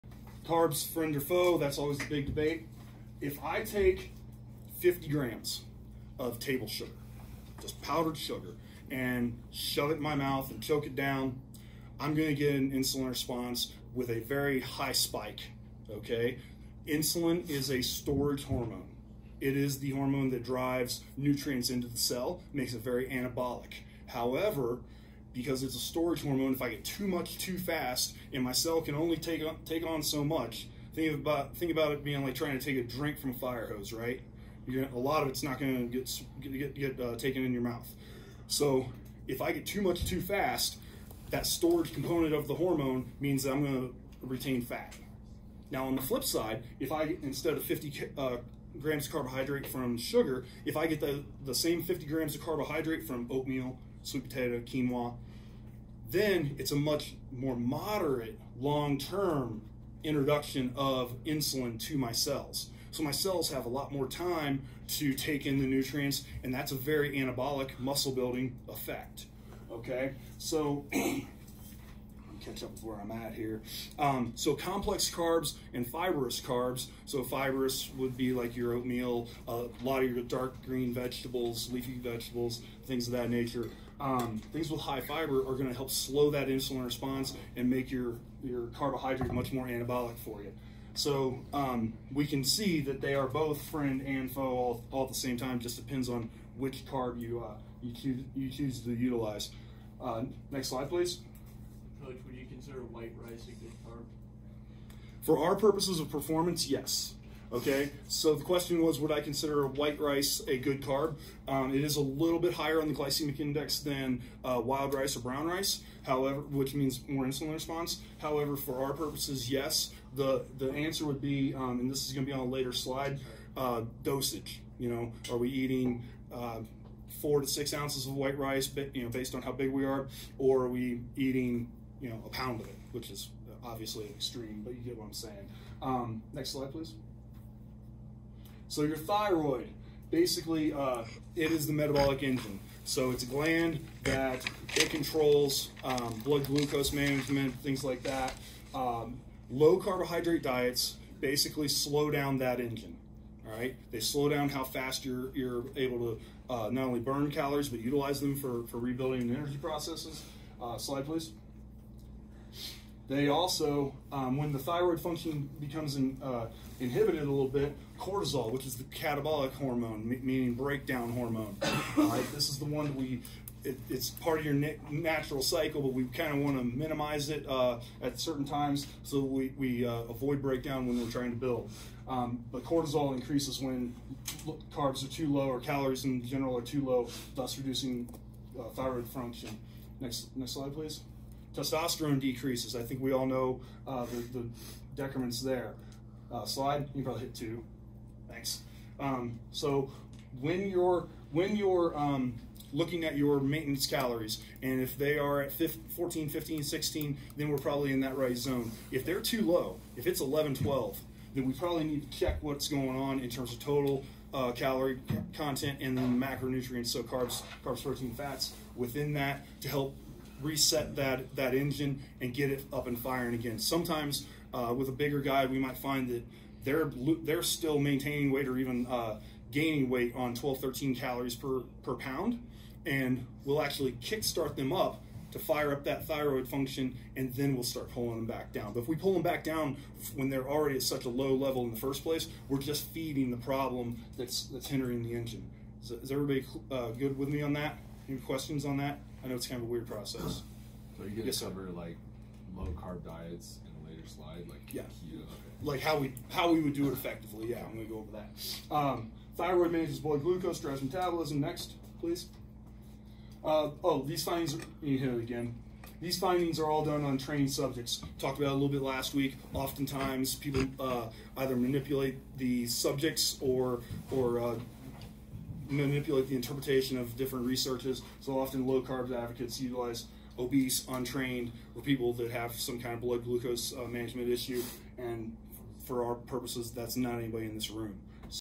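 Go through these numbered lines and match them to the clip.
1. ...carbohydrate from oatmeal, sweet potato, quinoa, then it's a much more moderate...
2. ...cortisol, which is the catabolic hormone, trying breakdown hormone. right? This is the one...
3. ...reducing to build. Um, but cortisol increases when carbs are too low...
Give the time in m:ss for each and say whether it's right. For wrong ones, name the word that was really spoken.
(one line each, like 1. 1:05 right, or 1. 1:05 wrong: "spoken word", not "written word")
1. 0:52 right
2. 2:47 wrong: "meaning", not "trying"
3. 3:01 wrong: "trying", not "reducing".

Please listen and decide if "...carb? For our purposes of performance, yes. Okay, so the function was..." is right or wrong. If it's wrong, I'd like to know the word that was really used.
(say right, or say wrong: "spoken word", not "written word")
wrong: "question", not "function".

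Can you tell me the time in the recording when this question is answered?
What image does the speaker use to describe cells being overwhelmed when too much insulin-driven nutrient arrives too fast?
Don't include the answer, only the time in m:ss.
0:33.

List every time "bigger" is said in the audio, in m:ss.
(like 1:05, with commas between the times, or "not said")
3:44.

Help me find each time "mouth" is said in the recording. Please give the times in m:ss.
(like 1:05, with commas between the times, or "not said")
0:10, 0:37.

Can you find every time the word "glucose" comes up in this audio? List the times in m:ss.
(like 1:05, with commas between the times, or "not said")
2:26, 4:20, 4:43.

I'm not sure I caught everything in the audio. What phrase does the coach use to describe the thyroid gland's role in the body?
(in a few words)
the metabolic engine.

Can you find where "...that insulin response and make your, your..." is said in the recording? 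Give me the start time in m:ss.
1:26.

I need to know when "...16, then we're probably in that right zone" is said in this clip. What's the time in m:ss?
3:26.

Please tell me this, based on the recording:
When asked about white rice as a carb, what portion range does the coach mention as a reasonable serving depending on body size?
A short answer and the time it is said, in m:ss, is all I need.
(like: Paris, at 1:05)
4 to 6 ounces, at 2:07.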